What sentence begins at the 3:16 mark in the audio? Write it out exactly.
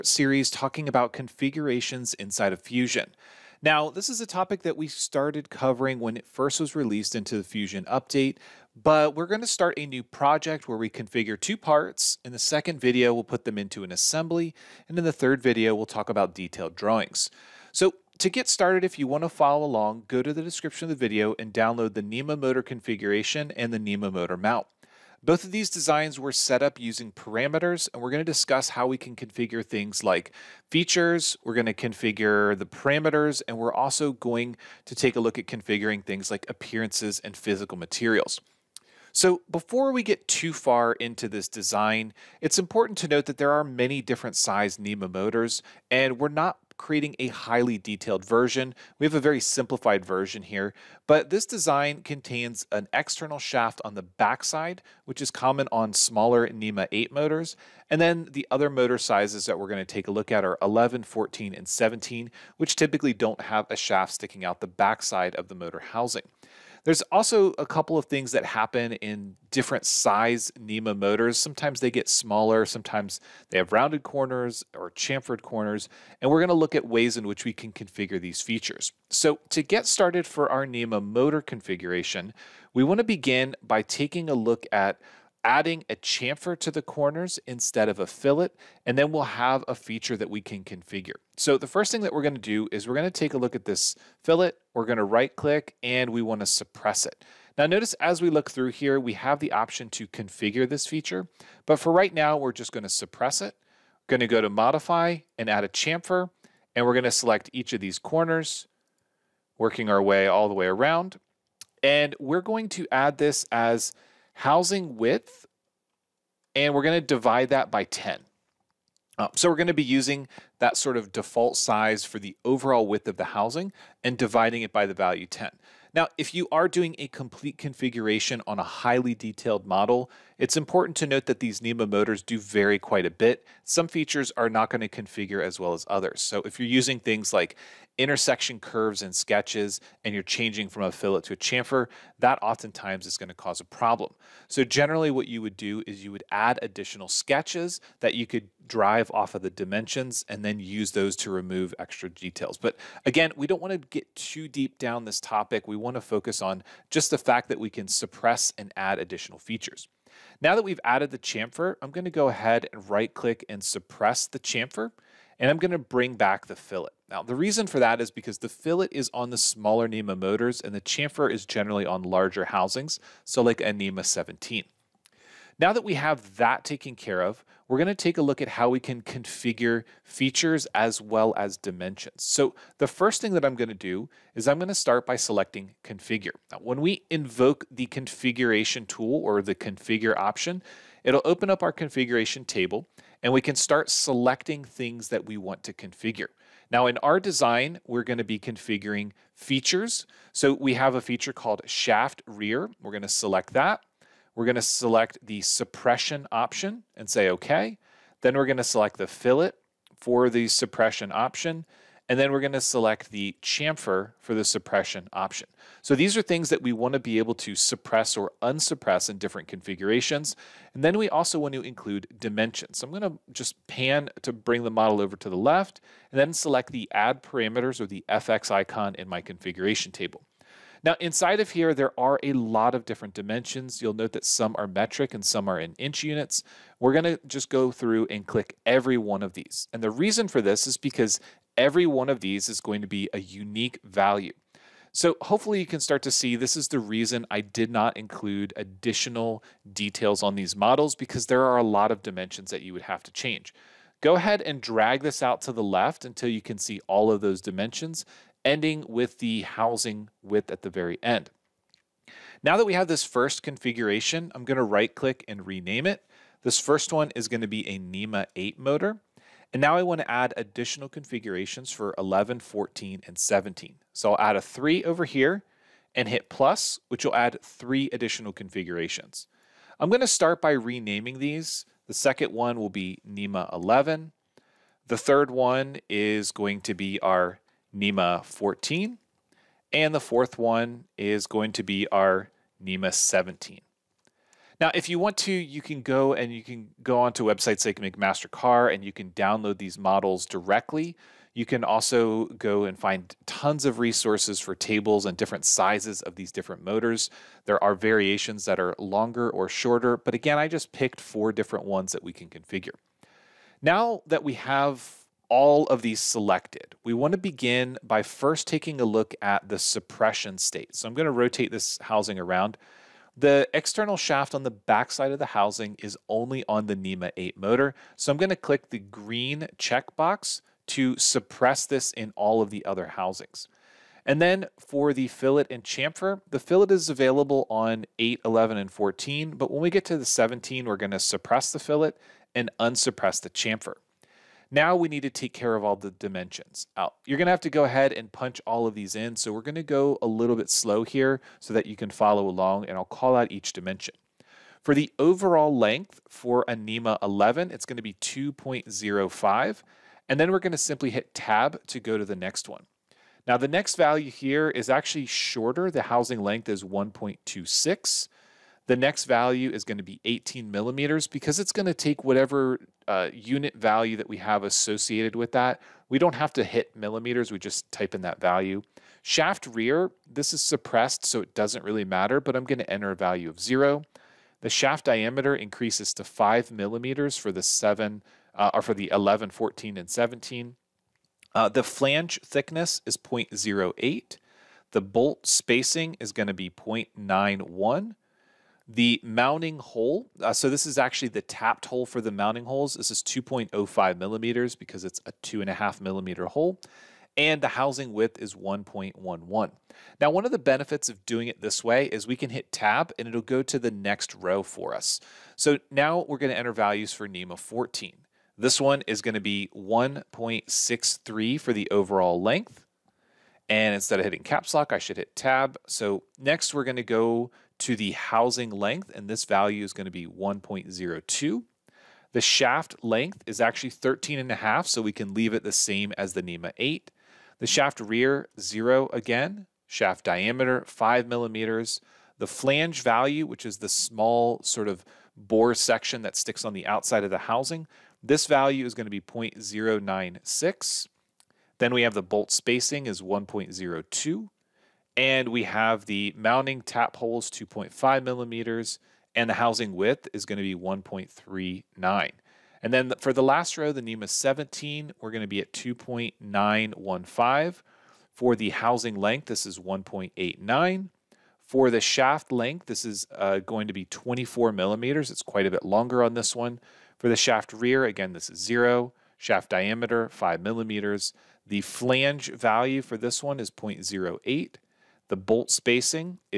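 Now in our design, we're going to be configuring features.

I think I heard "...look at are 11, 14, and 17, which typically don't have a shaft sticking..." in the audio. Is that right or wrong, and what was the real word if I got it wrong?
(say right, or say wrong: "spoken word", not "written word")
right.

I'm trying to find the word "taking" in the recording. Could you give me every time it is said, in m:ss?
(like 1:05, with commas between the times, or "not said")
1:23, 5:18.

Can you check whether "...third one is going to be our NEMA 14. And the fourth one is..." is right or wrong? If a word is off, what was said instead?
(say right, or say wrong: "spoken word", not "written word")
right.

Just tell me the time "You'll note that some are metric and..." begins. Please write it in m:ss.
3:53.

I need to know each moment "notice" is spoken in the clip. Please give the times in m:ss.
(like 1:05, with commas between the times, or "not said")
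1:37.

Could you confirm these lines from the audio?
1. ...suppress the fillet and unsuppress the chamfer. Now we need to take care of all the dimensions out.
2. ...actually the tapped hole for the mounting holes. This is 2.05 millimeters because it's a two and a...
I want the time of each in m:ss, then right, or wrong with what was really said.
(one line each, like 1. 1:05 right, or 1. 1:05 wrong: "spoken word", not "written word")
1. 5:40 right
2. 6:40 right.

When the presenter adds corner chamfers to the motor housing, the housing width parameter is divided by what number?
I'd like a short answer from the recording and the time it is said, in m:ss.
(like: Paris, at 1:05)
10, at 1:57.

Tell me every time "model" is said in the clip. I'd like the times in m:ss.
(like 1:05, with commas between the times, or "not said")
2:09, 3:44, 4:10, 4:59.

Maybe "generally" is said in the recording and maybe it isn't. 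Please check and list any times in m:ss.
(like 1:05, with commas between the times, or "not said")
2:24, 2:51.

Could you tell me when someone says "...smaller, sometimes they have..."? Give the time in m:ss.
1:12.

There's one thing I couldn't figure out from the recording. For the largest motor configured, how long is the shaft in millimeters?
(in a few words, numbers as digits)
24 millimeters.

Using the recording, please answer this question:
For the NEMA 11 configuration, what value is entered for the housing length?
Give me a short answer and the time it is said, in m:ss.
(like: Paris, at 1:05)
1.26, at 6:06.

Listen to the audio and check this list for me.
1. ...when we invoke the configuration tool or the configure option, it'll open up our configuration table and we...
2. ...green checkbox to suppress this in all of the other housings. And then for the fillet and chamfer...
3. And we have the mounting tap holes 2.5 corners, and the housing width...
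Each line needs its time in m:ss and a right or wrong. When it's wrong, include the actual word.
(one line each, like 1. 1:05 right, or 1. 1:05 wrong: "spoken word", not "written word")
1. 3:06 right
2. 5:28 right
3. 7:34 wrong: "millimeters", not "corners".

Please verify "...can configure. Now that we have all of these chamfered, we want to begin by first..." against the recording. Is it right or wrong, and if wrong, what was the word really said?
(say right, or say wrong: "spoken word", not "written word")
wrong: "selected", not "chamfered".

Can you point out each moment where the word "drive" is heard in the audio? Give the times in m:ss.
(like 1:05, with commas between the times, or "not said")
2:28.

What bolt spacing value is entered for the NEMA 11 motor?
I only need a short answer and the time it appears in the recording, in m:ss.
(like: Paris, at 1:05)
0.91, at 6:36.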